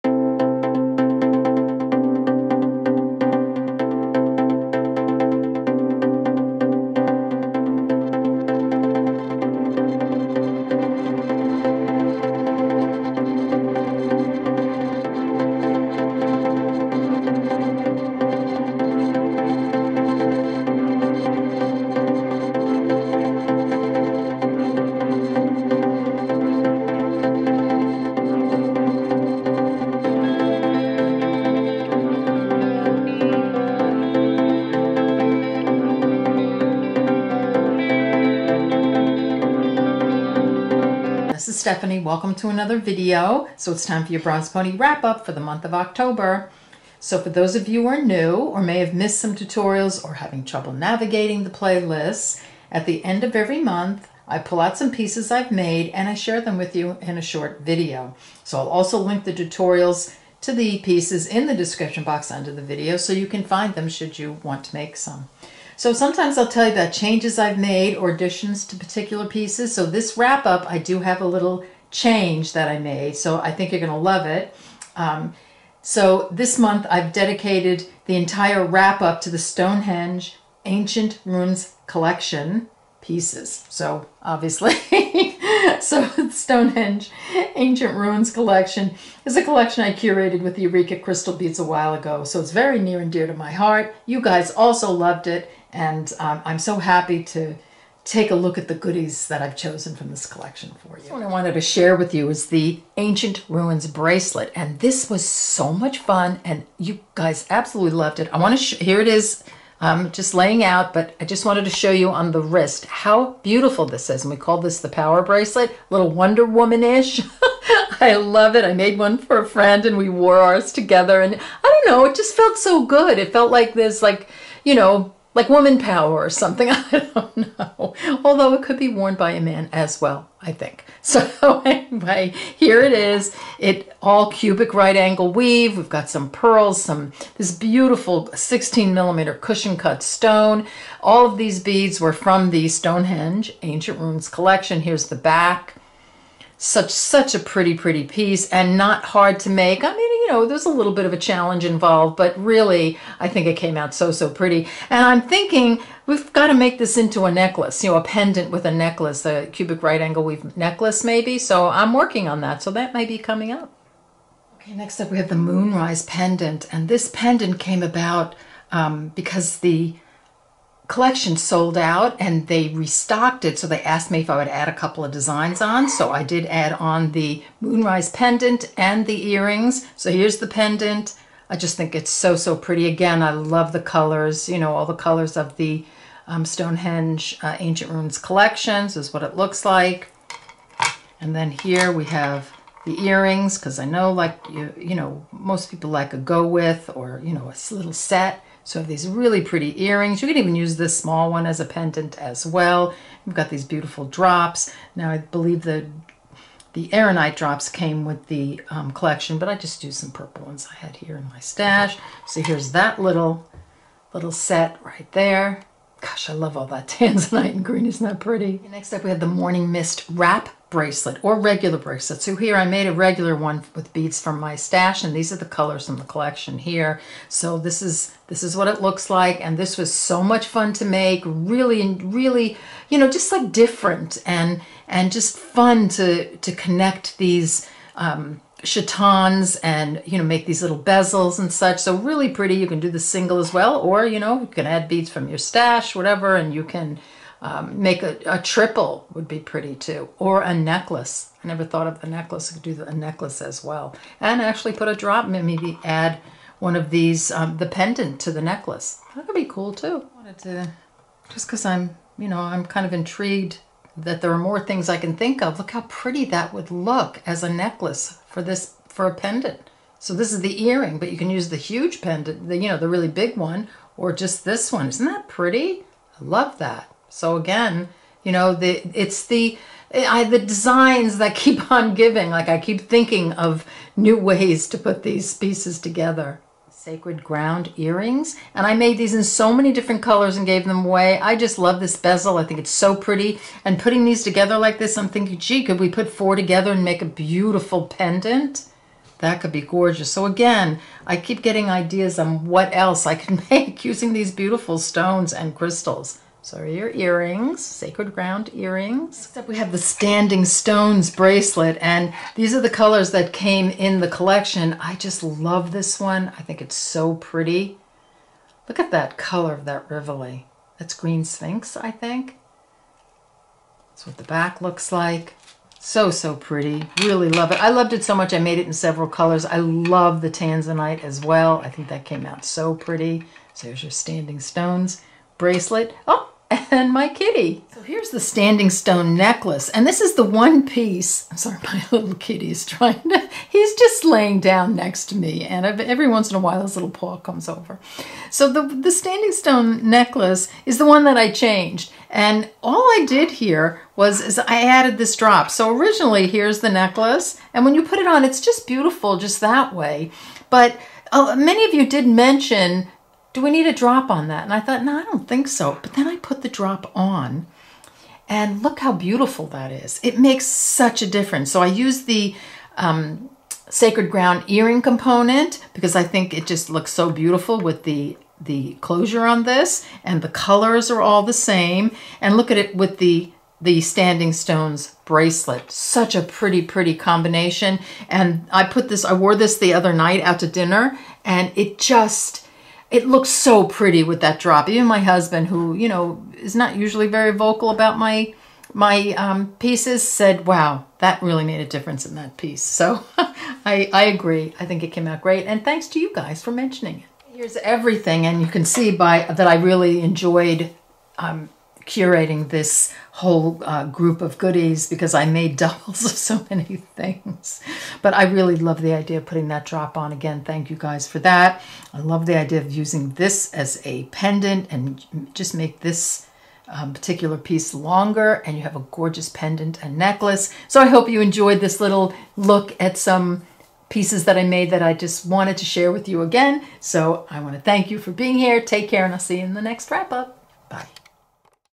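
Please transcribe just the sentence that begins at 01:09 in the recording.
So this wrap up, I do have a little change that I made.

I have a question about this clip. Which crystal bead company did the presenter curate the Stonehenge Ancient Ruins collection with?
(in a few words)
Eureka Crystal Beads.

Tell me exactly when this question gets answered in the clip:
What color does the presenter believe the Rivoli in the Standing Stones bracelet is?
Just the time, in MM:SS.
05:20.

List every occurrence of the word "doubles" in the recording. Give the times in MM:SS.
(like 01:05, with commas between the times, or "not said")
06:55.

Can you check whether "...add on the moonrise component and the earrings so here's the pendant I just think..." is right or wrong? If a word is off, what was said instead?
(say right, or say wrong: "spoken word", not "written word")
wrong: "pendant", not "component".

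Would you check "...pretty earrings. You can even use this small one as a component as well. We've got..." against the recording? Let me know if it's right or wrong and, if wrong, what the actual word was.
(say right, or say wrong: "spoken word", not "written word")
wrong: "pendant", not "component".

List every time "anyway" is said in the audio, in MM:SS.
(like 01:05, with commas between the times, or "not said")
02:11.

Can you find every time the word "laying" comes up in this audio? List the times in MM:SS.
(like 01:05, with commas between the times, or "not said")
01:50, 05:44.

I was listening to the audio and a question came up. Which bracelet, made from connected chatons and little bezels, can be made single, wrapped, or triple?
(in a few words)
Morning Mist.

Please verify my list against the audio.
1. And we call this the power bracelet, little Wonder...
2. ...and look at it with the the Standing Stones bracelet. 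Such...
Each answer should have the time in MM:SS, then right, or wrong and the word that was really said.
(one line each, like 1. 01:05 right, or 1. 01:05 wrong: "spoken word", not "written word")
1. 01:54 right
2. 06:22 right.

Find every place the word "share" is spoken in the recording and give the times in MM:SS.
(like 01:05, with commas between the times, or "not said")
00:56, 01:41, 07:15.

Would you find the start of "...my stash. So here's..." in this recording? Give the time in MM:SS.
03:31.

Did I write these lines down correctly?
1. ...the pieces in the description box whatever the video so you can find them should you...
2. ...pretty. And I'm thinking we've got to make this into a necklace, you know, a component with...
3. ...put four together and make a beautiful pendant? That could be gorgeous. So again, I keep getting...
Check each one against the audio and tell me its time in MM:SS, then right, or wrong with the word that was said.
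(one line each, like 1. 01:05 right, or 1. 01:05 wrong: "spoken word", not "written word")
1. 01:00 wrong: "under", not "whatever"
2. 02:34 wrong: "pendant", not "component"
3. 04:55 right.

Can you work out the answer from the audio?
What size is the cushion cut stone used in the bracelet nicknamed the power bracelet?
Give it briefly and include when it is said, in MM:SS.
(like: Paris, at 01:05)
16 millimeter, at 02:18.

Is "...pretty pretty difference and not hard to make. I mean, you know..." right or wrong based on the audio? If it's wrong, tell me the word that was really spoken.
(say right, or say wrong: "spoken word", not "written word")
wrong: "piece", not "difference".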